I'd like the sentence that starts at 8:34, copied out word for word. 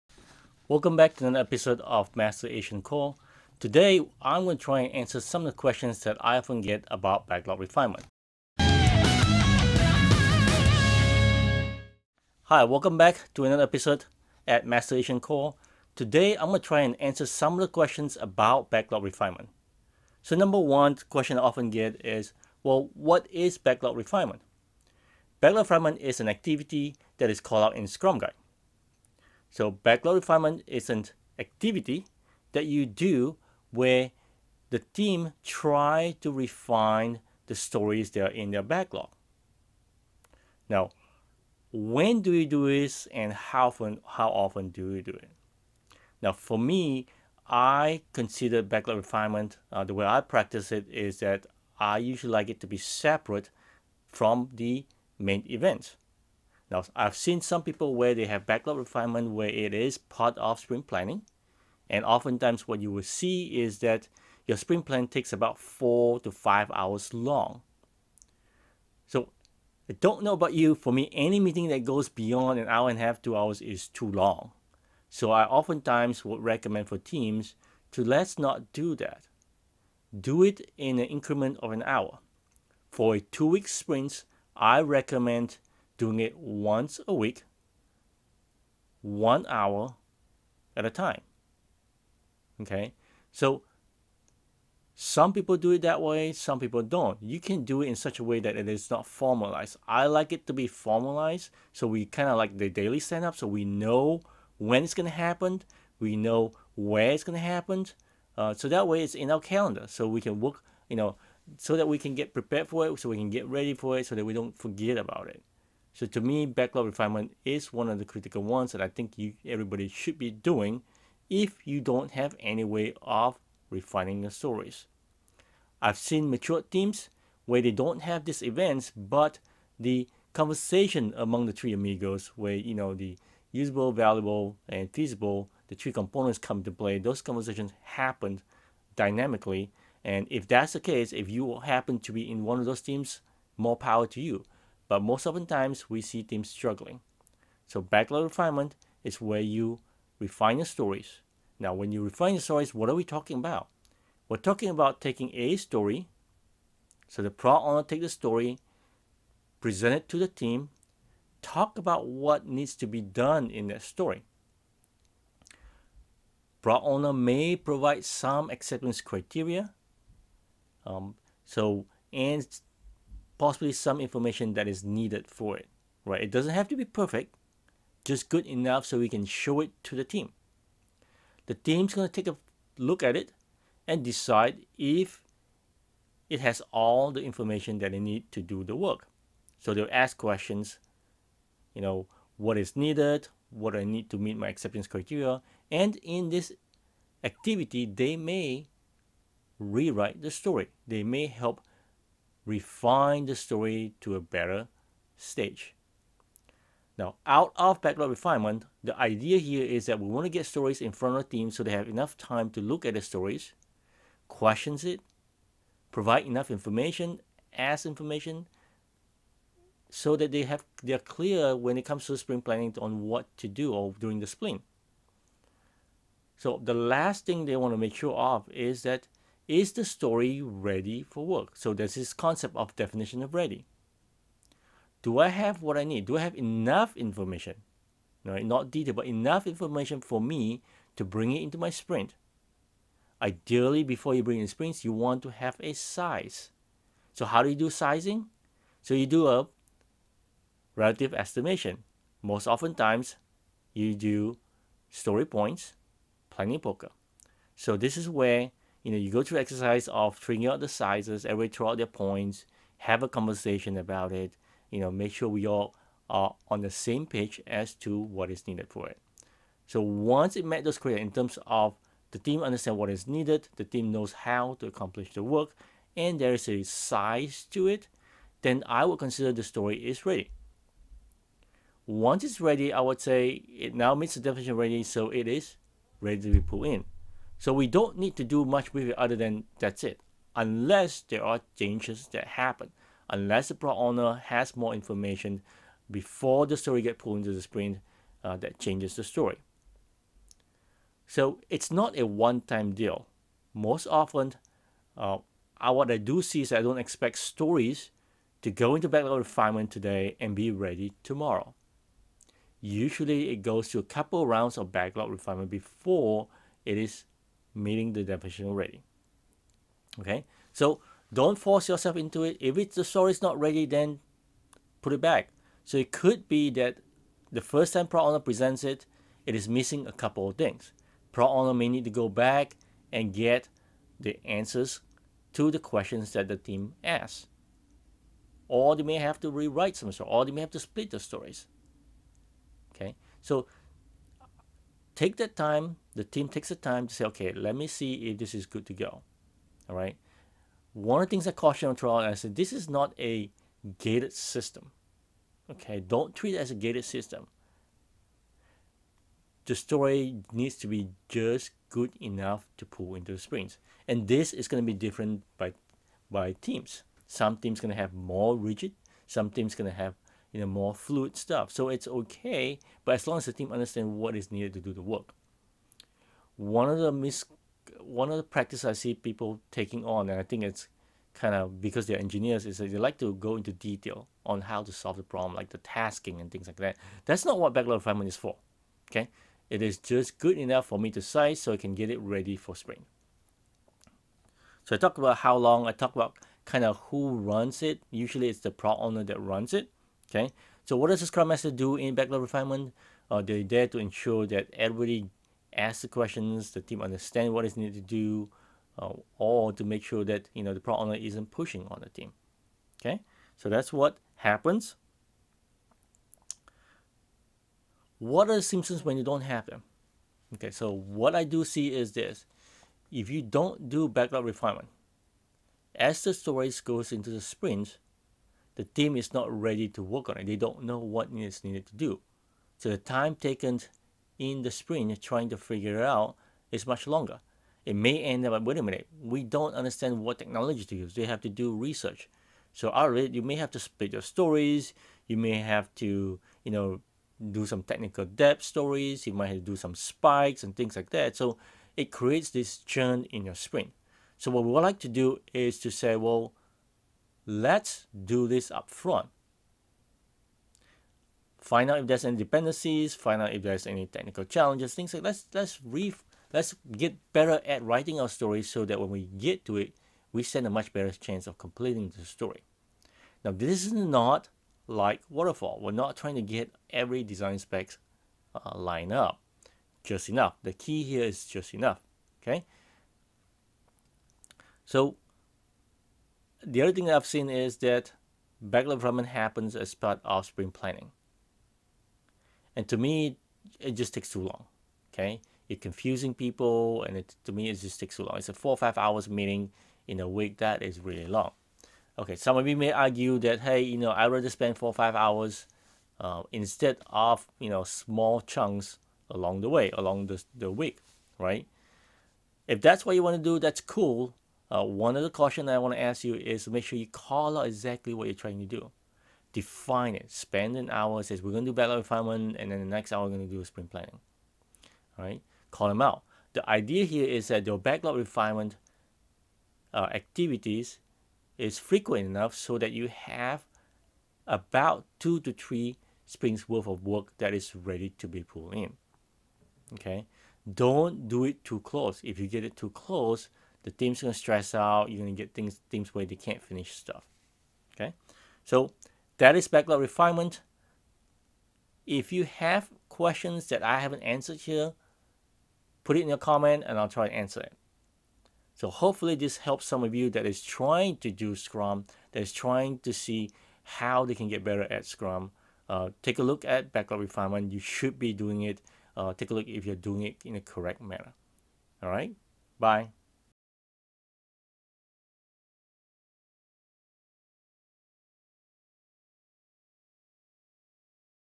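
Uh, one other caution I want to ask you is make sure you call out exactly what you're trying to do.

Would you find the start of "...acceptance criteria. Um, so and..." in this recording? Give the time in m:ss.
2:48.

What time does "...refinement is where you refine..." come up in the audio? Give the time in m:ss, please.
2:28.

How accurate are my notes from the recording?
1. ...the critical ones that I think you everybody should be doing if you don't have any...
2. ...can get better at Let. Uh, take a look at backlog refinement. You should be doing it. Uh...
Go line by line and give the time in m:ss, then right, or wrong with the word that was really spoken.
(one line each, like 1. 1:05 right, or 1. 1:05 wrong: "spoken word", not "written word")
1. 1:57 right
2. 9:24 wrong: "Scrum", not "Let".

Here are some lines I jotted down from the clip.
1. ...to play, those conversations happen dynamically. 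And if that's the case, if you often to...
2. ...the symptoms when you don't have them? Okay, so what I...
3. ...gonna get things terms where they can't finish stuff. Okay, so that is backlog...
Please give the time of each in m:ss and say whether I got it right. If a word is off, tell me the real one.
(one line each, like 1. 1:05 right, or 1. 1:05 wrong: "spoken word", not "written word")
1. 2:16 wrong: "happen", not "often"
2. 6:58 right
3. 9:04 wrong: "teams", not "terms".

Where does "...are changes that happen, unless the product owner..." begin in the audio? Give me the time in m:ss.
4:51.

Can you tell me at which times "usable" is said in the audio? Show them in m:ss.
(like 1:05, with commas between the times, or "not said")
2:13.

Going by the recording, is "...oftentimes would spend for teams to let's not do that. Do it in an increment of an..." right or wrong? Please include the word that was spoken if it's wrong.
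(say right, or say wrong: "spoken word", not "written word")
wrong: "recommend", not "spend".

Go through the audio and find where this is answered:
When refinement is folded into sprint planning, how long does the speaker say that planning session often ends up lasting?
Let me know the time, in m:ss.
1:05.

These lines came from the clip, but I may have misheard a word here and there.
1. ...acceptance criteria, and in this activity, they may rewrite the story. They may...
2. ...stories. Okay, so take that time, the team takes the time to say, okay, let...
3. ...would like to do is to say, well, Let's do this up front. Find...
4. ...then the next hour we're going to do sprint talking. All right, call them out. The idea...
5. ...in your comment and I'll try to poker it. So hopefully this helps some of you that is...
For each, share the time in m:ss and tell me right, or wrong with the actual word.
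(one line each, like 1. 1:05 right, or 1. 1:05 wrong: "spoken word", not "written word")
1. 3:14 right
2. 5:40 right
3. 7:34 right
4. 8:42 wrong: "planning", not "talking"
5. 9:16 wrong: "answer", not "poker".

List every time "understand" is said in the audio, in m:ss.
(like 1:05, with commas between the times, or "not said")
4:32, 6:13, 6:46, 7:19.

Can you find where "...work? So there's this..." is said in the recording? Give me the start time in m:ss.
3:51.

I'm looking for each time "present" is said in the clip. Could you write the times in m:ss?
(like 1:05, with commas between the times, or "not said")
2:39, 5:28.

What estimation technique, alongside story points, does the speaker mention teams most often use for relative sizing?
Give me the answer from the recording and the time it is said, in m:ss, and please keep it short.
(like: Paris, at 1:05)
planning poker, at 4:16.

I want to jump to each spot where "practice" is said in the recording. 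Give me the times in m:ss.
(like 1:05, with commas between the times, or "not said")
0:50, 6:18.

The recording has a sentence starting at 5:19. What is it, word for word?
Okay, so don't force yourself into it.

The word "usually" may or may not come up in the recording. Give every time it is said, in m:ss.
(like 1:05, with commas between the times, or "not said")
0:51, 5:12, 6:37.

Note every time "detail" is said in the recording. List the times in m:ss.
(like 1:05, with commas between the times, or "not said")
3:58, 6:23.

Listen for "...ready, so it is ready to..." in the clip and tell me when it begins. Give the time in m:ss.
4:44.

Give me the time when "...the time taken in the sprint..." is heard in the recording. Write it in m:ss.
7:12.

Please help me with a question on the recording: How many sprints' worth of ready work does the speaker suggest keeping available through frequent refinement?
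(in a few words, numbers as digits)
2 to 3.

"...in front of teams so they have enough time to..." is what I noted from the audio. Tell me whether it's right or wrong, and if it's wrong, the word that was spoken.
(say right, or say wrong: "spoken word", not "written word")
right.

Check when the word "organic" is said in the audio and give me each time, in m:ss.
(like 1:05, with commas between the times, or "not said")
not said.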